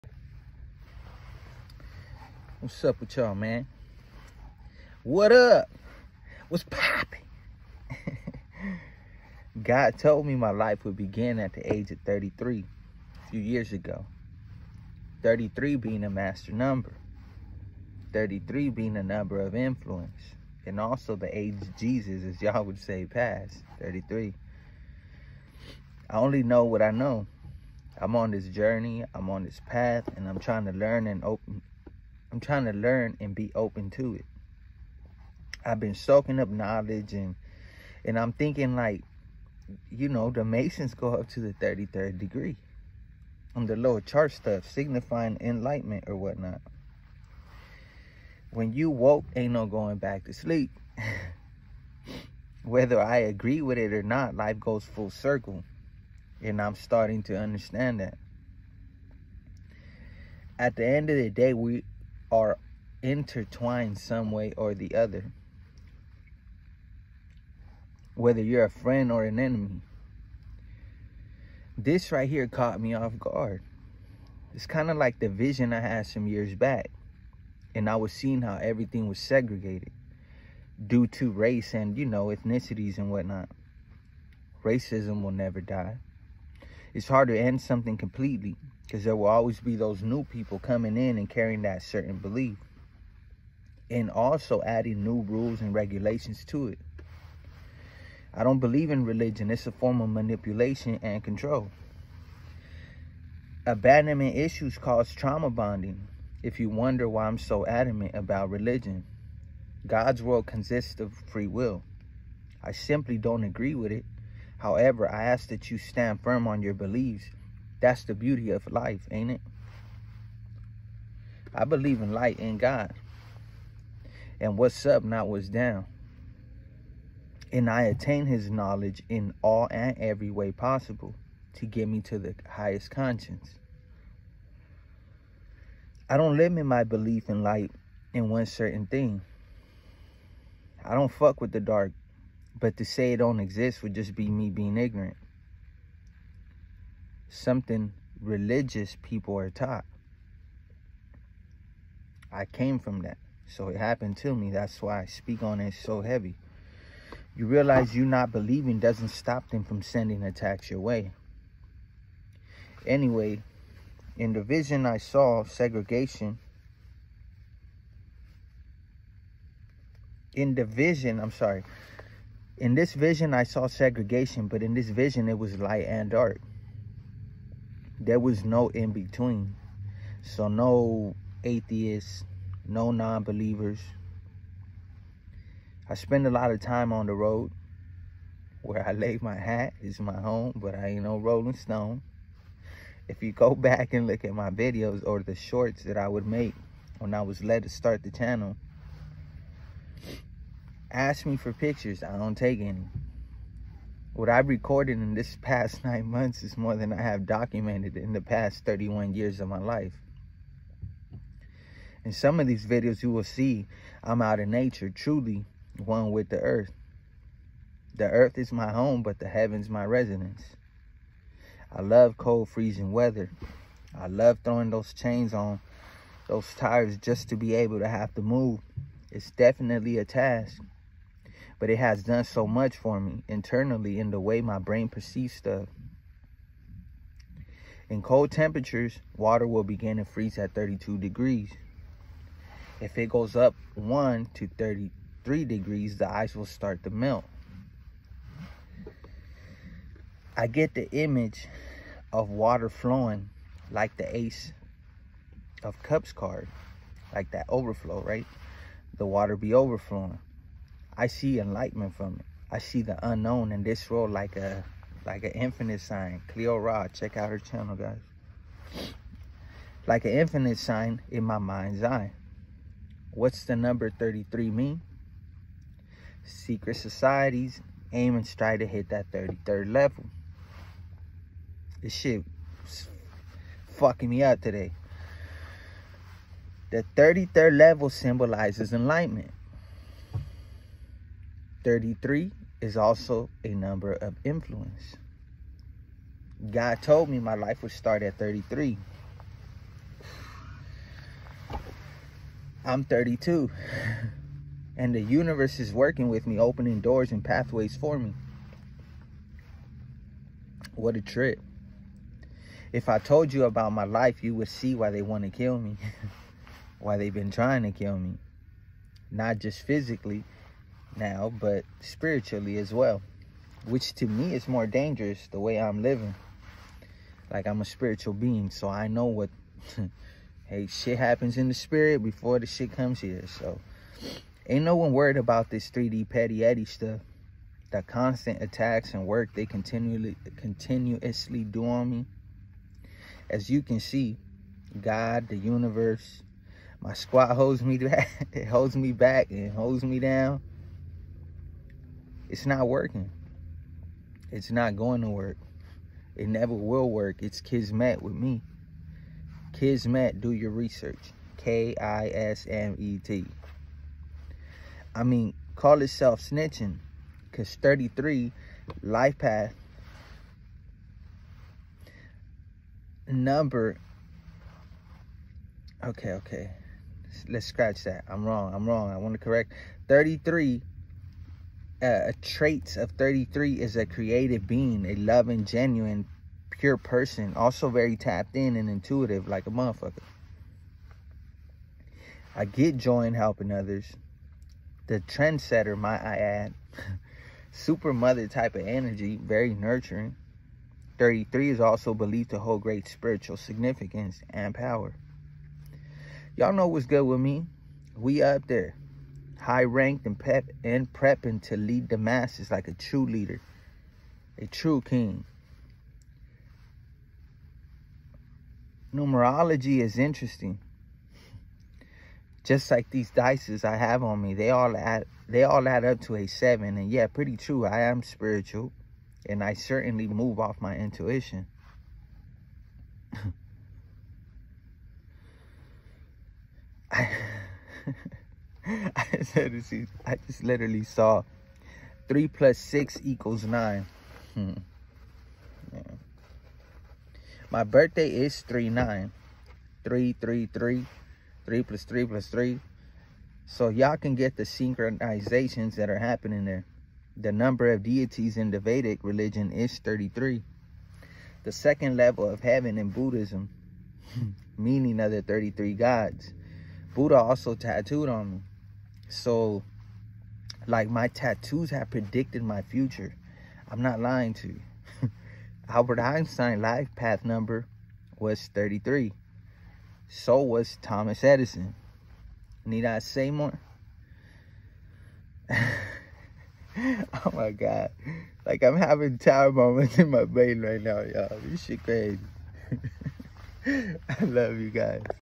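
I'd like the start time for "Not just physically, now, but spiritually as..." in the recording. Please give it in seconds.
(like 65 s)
319 s.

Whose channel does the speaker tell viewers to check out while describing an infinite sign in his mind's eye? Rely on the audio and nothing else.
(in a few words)
Cleo Rod.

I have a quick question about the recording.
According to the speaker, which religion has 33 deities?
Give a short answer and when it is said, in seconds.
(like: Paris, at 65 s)
Vedic, at 458 s.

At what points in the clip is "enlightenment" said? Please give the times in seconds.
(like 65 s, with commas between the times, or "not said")
45 s, 261 s, 288 s.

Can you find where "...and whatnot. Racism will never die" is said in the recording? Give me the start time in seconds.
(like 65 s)
82 s.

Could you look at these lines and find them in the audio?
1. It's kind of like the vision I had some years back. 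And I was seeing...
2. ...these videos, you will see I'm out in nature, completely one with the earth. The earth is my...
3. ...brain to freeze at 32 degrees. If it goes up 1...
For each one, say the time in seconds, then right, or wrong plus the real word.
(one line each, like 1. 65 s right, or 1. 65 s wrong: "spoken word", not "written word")
1. 74 s right
2. 212 s wrong: "truly", not "completely"
3. 239 s wrong: "begin", not "brain".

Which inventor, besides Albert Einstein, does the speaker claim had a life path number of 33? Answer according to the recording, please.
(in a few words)
Thomas Edison.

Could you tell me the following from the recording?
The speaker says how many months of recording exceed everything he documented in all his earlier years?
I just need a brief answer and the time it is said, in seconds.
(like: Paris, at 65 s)
9, at 205 s.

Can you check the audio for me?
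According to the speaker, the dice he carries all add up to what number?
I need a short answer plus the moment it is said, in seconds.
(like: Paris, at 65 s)
7, at 426 s.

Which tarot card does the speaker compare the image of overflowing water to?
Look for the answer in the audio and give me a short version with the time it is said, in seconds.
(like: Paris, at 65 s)
Ace of Cups, at 254 s.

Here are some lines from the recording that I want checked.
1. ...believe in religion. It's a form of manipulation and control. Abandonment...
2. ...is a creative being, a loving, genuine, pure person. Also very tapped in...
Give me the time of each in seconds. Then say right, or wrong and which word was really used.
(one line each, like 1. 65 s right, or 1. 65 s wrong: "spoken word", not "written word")
1. 98 s right
2. 383 s right.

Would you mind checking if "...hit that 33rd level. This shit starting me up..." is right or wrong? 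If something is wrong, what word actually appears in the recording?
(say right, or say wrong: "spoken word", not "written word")
wrong: "fucking", not "starting".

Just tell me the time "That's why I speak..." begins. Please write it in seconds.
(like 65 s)
154 s.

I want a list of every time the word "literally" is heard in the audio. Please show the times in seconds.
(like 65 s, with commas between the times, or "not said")
440 s.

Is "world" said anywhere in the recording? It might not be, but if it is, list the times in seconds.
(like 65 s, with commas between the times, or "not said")
110 s, 263 s.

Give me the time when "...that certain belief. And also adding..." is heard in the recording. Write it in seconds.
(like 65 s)
91 s.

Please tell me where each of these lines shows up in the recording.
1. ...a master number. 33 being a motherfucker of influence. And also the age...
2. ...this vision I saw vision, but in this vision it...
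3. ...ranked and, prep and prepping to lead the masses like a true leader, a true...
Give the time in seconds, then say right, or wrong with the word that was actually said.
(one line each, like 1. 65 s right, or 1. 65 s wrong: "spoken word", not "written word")
1. 16 s wrong: "number", not "motherfucker"
2. 172 s wrong: "segregation", not "vision"
3. 409 s right.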